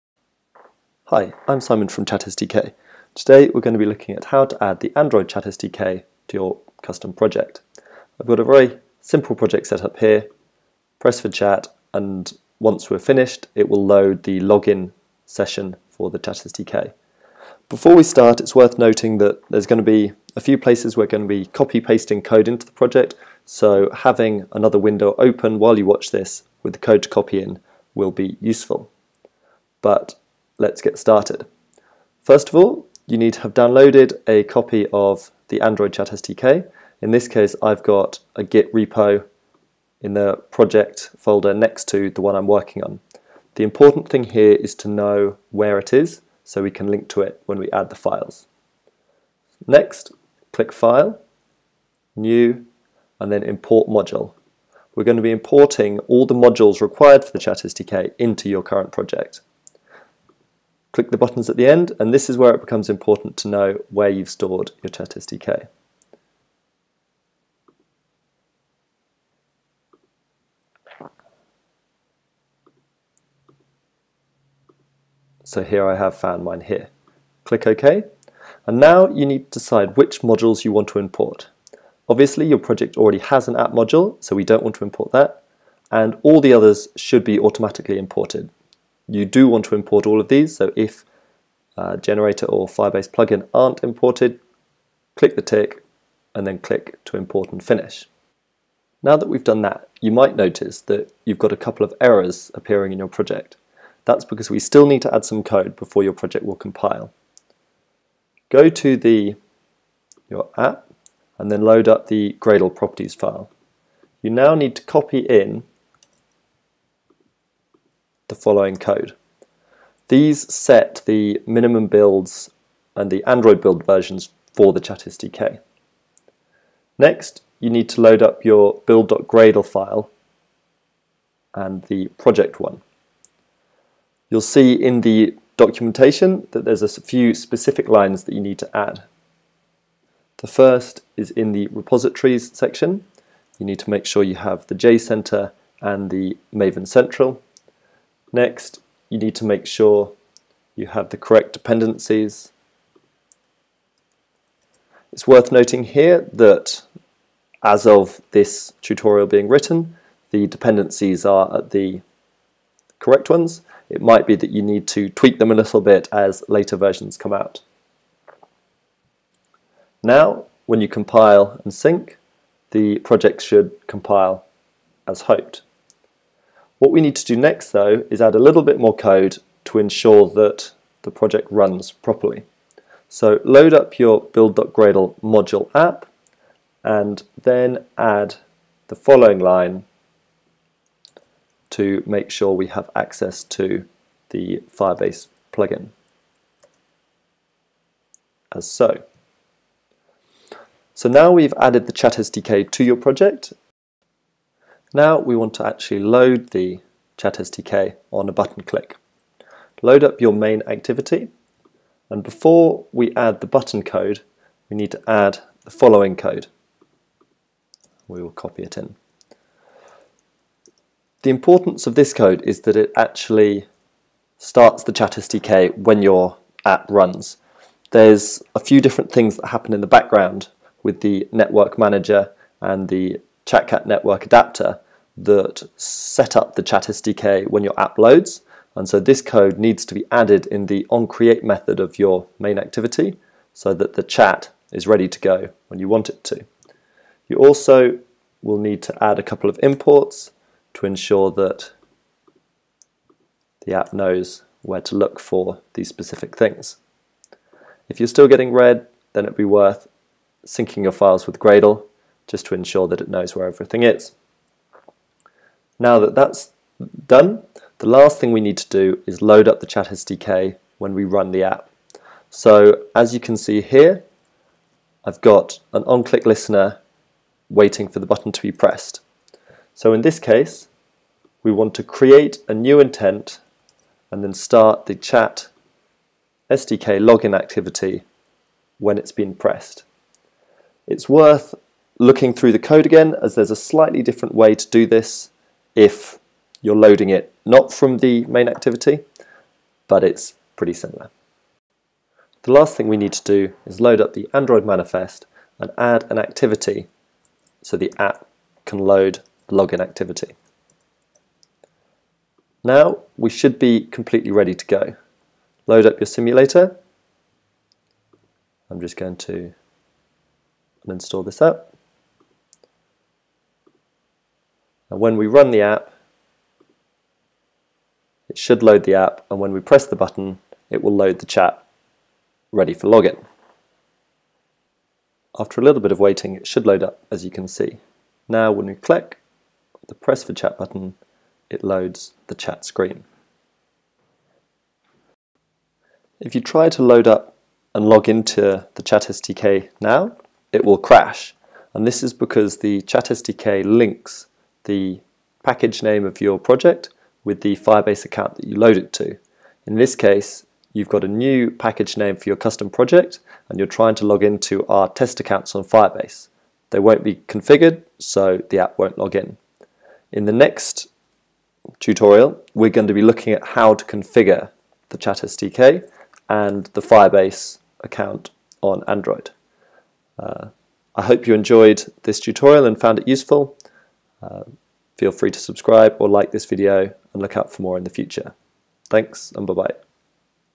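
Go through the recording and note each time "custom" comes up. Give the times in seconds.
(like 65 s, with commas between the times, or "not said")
6 s, 362 s.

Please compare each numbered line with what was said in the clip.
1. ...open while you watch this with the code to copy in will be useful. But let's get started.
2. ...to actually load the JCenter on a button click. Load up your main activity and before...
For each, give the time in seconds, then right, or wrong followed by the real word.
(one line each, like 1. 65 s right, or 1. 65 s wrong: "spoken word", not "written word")
1. 25 s right
2. 205 s wrong: "ChatSDK", not "JCenter".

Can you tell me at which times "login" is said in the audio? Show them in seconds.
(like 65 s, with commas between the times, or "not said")
14 s, 287 s, 309 s, 332 s.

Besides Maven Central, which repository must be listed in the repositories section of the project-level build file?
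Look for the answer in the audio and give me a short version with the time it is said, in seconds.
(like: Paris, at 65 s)
JCenter, at 144 s.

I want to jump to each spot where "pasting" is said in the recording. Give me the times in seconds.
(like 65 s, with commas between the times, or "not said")
21 s.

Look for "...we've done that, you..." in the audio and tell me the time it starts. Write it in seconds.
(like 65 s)
99 s.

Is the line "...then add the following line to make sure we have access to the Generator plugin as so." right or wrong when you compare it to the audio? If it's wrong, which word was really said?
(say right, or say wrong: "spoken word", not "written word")
wrong: "Firebase", not "Generator".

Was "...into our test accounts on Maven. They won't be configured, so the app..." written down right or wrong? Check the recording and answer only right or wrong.
wrong.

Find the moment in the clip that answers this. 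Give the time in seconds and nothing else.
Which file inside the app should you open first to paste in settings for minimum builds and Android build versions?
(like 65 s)
112 s.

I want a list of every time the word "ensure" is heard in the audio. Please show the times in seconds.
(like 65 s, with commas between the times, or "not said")
179 s, 250 s, 262 s.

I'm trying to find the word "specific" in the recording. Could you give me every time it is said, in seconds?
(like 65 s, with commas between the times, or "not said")
137 s, 255 s.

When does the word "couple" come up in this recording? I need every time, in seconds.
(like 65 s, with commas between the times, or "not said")
101 s, 249 s.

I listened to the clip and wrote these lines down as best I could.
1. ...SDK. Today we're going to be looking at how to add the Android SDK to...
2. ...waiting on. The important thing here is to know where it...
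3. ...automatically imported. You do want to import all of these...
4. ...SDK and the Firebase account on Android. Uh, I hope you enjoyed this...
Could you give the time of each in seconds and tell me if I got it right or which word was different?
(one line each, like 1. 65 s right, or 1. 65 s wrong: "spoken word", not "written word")
1. 2 s right
2. 42 s wrong: "working", not "waiting"
3. 87 s right
4. 375 s right.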